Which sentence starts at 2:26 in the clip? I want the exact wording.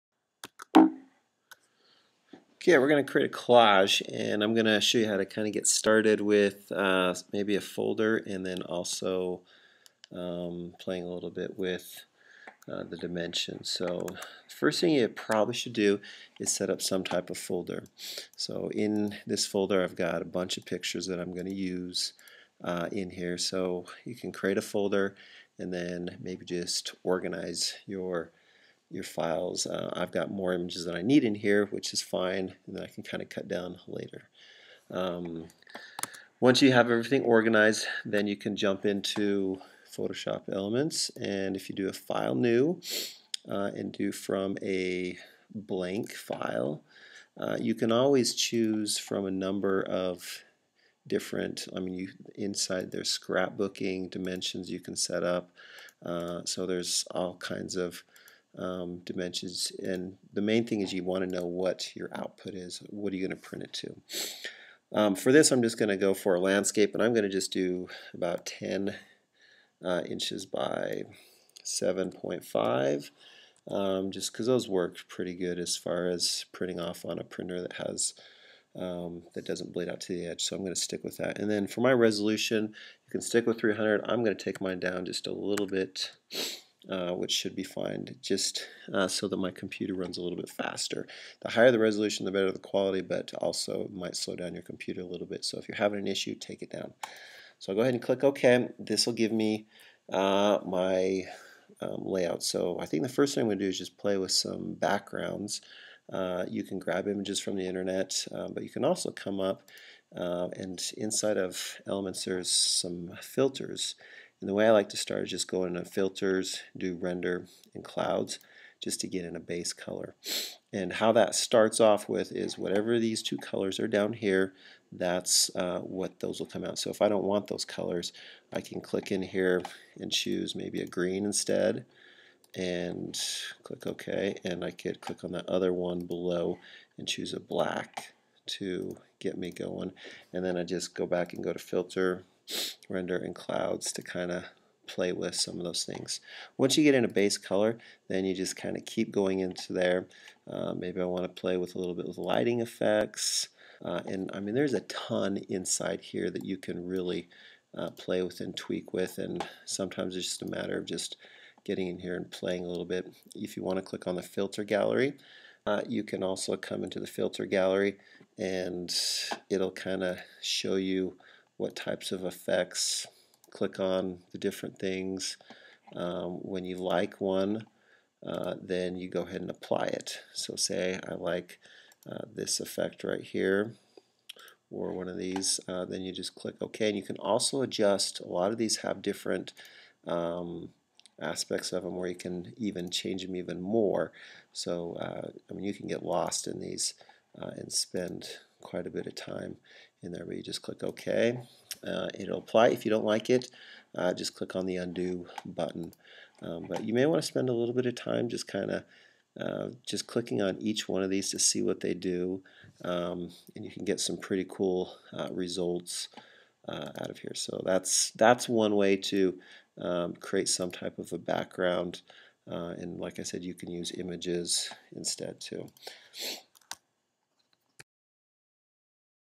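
Once you get in a base color, then you just kind of keep going into there.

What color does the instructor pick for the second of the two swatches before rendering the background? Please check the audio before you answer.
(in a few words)
Black.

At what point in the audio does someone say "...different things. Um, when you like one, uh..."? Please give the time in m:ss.
2:54.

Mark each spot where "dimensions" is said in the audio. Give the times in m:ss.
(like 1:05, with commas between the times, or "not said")
0:12, 0:54, 0:59.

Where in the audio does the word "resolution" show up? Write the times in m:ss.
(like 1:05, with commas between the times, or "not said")
1:21, 1:31.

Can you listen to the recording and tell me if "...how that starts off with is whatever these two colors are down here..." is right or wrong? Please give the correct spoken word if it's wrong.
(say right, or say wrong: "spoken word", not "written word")
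right.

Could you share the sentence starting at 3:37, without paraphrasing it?
So that's, that's one way to um, create some type of a background.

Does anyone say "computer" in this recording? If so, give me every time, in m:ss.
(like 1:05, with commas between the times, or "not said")
1:29, 1:34.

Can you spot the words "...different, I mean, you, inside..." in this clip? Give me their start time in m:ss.
0:51.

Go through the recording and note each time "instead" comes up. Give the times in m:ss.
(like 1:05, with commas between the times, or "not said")
2:11, 3:44.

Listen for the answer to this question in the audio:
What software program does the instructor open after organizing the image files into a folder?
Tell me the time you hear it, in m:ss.
0:39.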